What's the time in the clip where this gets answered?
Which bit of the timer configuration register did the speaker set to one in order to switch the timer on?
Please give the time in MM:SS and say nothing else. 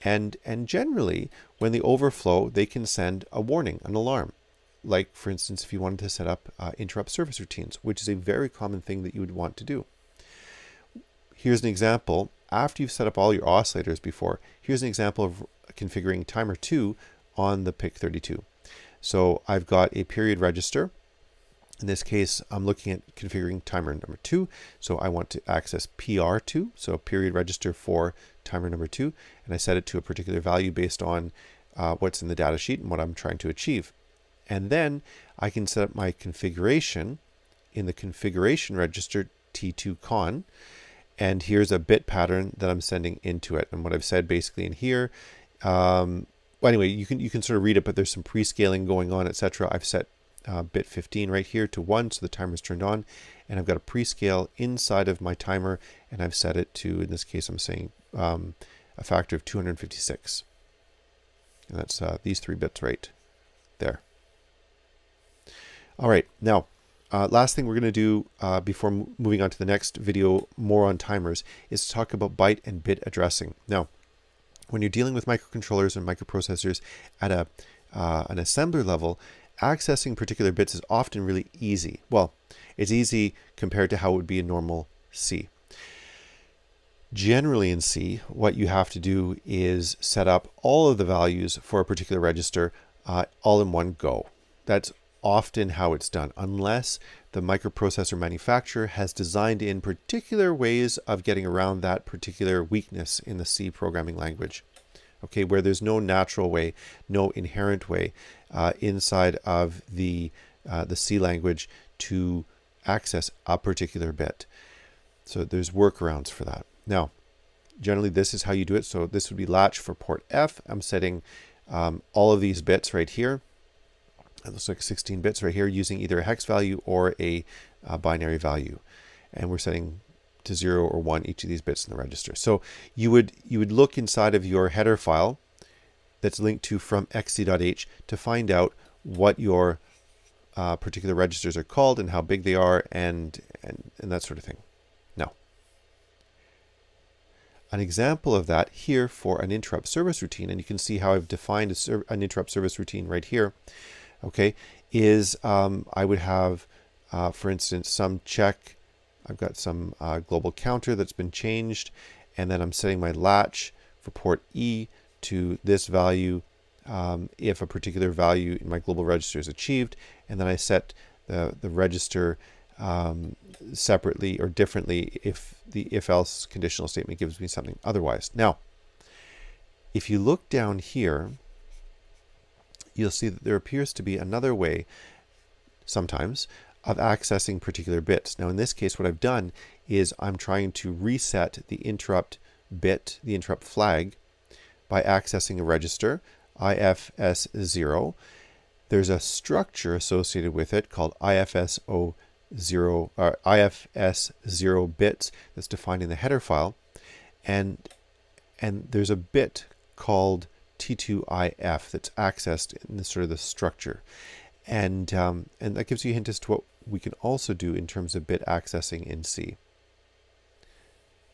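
00:50.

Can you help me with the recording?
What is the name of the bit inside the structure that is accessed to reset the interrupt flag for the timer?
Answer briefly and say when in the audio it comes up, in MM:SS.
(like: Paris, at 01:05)
T2IF, at 03:30.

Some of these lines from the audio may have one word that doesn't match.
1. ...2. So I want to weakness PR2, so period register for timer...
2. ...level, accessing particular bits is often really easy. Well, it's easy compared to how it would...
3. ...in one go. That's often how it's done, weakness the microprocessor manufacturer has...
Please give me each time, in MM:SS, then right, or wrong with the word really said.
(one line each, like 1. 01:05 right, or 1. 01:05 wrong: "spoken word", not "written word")
1. 00:24 wrong: "access", not "weakness"
2. 01:18 right
3. 01:33 wrong: "unless", not "weakness".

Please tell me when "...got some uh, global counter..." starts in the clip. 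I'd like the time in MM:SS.
02:39.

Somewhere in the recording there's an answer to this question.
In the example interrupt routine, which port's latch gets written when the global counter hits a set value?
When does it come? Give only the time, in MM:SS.
02:44.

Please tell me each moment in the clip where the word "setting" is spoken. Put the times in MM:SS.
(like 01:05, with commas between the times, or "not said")
02:00, 02:09, 02:42.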